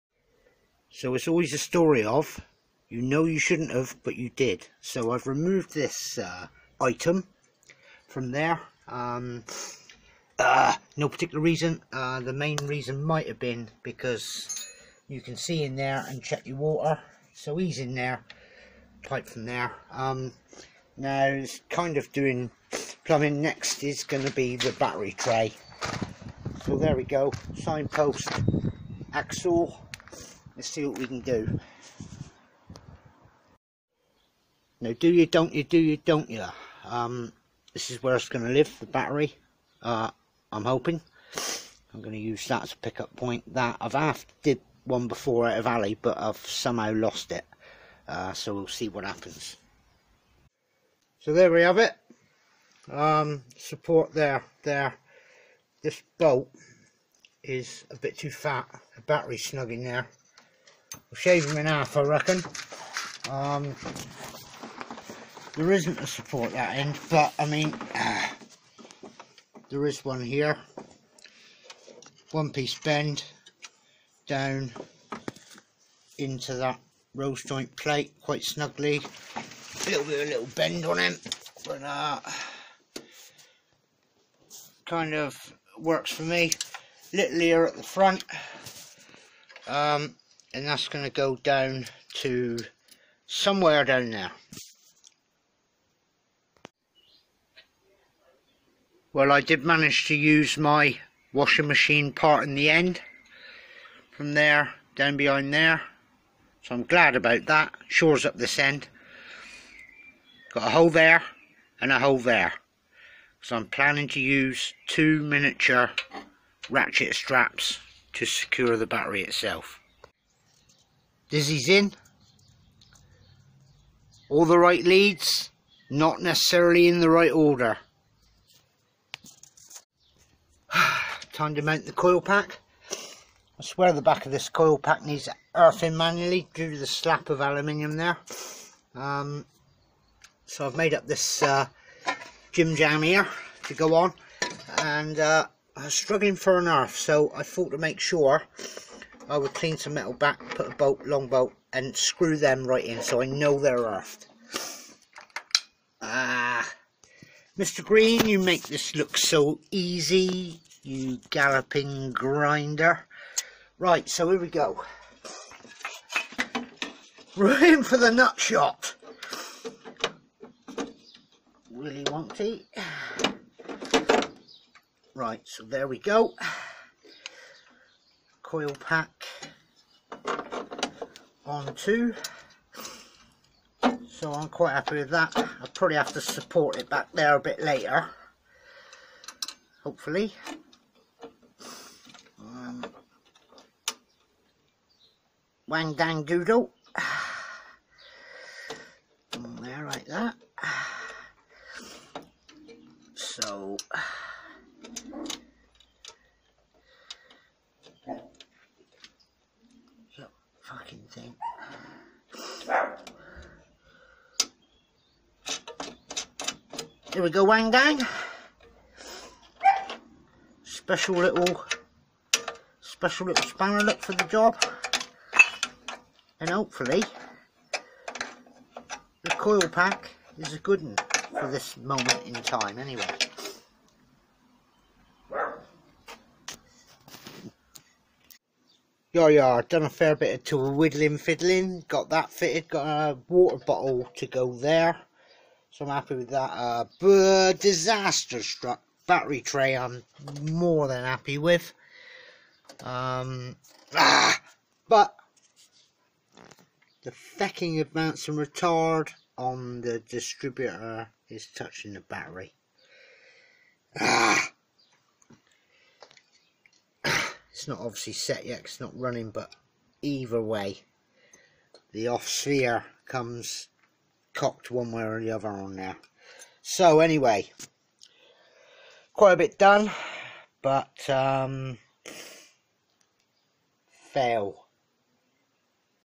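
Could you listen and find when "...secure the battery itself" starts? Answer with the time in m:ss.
1:58.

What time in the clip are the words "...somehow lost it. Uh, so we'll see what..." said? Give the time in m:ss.
0:46.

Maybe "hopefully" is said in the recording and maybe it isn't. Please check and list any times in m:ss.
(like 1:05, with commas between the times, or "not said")
3:09, 3:46.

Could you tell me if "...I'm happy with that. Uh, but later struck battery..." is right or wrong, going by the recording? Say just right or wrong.
wrong.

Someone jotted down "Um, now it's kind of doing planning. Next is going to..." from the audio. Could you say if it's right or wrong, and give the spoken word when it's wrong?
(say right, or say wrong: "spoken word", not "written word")
wrong: "plumbing", not "planning".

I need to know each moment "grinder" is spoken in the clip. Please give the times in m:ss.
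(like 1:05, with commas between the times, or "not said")
2:42.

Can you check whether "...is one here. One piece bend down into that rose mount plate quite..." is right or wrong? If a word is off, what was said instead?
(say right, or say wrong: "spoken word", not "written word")
wrong: "joint", not "mount".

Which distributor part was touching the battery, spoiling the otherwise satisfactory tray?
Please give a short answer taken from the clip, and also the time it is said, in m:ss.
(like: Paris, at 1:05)
Advance and retard, at 4:17.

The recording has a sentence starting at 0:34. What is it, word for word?
Now, do you, don't you, do you, don't you?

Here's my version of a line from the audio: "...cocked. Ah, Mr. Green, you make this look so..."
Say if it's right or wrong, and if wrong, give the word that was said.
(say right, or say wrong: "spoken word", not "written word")
wrong: "earthed", not "cocked".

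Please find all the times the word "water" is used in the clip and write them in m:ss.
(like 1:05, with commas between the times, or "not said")
0:16, 4:03.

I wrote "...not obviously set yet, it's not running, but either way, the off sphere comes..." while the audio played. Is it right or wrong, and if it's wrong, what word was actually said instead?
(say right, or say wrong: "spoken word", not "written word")
right.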